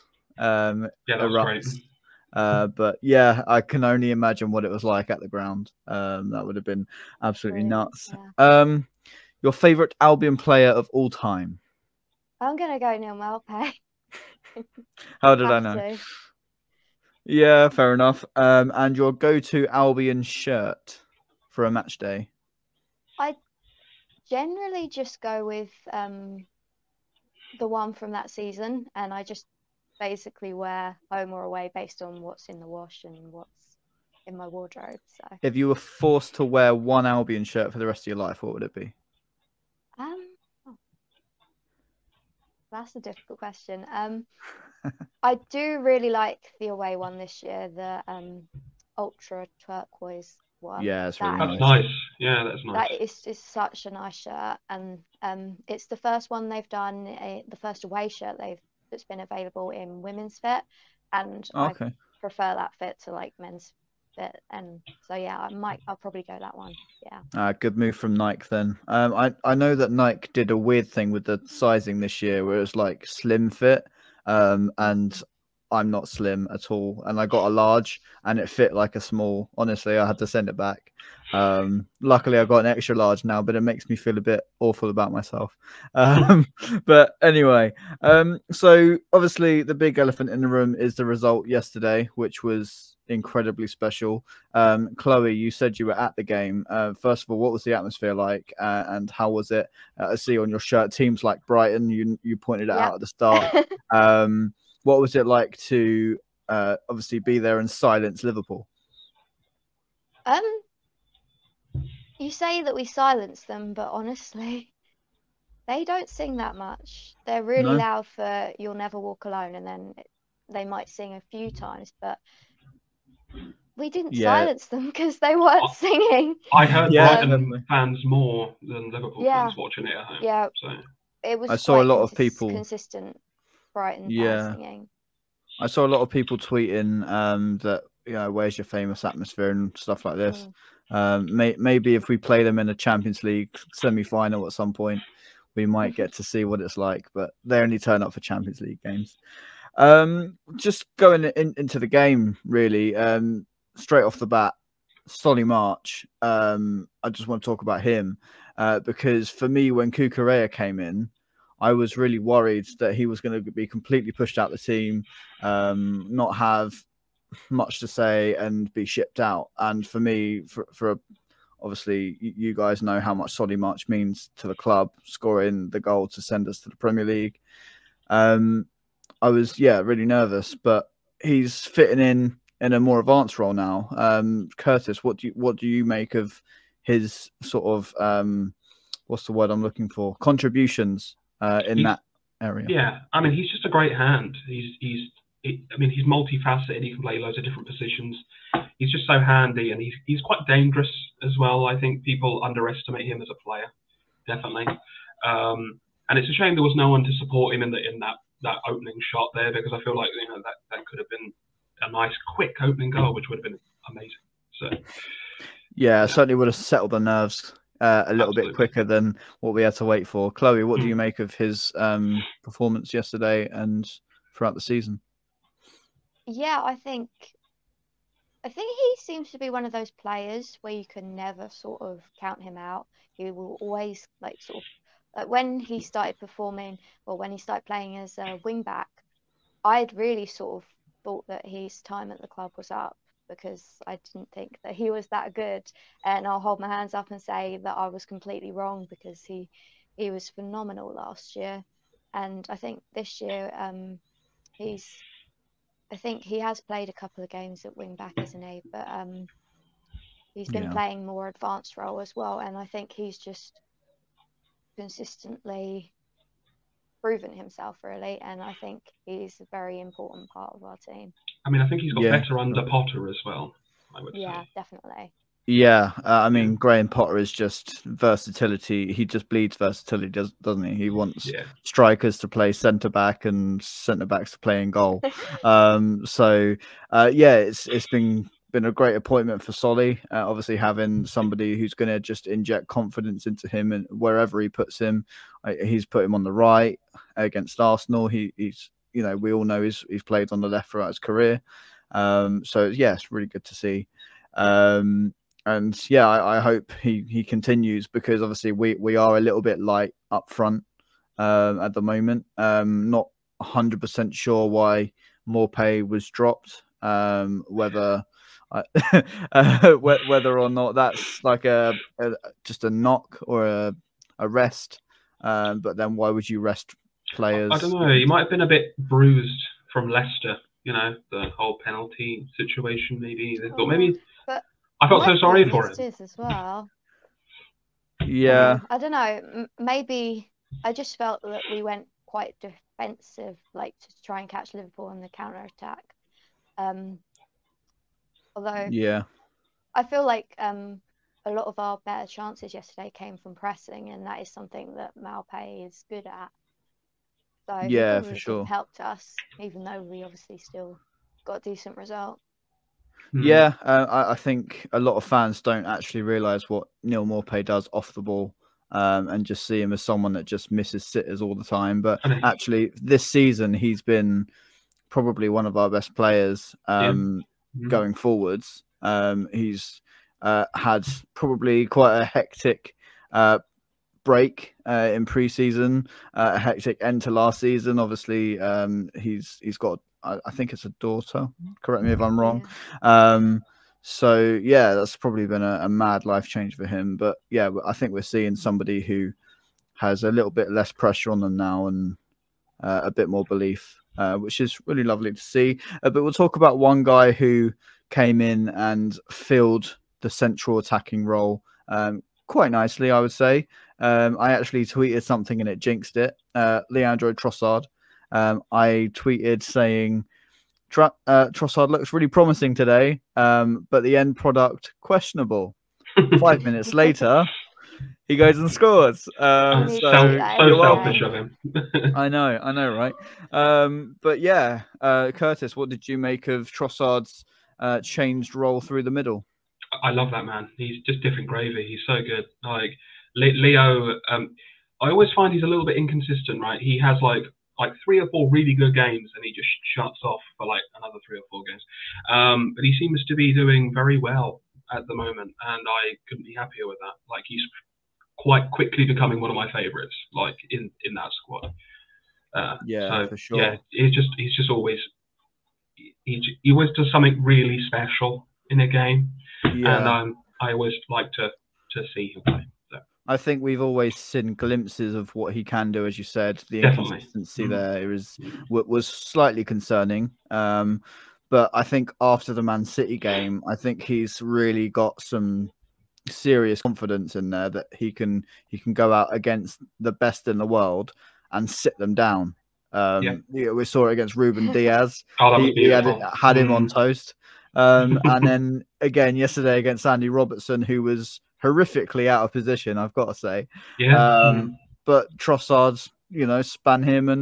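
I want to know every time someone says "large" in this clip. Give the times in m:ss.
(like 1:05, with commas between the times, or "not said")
1:17, 1:22.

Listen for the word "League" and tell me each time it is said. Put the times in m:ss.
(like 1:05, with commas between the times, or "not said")
2:23, 2:28, 2:57.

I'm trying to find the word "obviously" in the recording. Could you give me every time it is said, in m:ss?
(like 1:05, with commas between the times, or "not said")
1:29, 1:46, 2:51, 4:50, 5:08, 6:00, 6:27.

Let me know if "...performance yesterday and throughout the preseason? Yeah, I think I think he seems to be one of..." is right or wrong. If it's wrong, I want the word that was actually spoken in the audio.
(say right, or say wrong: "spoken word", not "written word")
wrong: "season", not "preseason".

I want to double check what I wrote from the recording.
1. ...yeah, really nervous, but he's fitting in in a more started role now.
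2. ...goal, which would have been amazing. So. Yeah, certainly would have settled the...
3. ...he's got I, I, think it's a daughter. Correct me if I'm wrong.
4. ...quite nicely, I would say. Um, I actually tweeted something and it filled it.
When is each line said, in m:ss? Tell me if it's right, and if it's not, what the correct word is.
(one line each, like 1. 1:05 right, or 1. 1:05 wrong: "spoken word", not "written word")
1. 2:59 wrong: "advanced", not "started"
2. 3:32 right
3. 6:29 right
4. 6:52 wrong: "jinxed", not "filled".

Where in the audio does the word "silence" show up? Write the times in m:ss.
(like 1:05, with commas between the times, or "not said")
1:47, 1:52, 2:04.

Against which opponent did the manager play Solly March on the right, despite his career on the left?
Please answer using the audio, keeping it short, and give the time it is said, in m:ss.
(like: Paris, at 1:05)
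Arsenal, at 4:57.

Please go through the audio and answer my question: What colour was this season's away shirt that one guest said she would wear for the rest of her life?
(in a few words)
Ultra turquoise.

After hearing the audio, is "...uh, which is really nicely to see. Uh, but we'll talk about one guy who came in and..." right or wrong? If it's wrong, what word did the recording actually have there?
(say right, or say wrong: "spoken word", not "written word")
wrong: "lovely", not "nicely".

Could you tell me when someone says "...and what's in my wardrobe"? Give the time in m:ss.
0:33.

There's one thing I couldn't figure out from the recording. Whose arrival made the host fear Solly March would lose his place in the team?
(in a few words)
Cucurella.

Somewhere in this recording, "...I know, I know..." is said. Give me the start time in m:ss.
7:11.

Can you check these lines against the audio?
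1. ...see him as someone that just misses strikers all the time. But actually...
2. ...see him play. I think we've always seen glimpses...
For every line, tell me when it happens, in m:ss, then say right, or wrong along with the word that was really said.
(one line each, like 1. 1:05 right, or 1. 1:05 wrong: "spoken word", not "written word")
1. 6:09 wrong: "sitters", not "strikers"
2. 7:51 right.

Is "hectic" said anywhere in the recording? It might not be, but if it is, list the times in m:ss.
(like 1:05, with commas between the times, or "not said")
6:22, 6:26.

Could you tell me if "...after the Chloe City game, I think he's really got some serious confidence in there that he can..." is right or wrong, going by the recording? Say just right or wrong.
wrong.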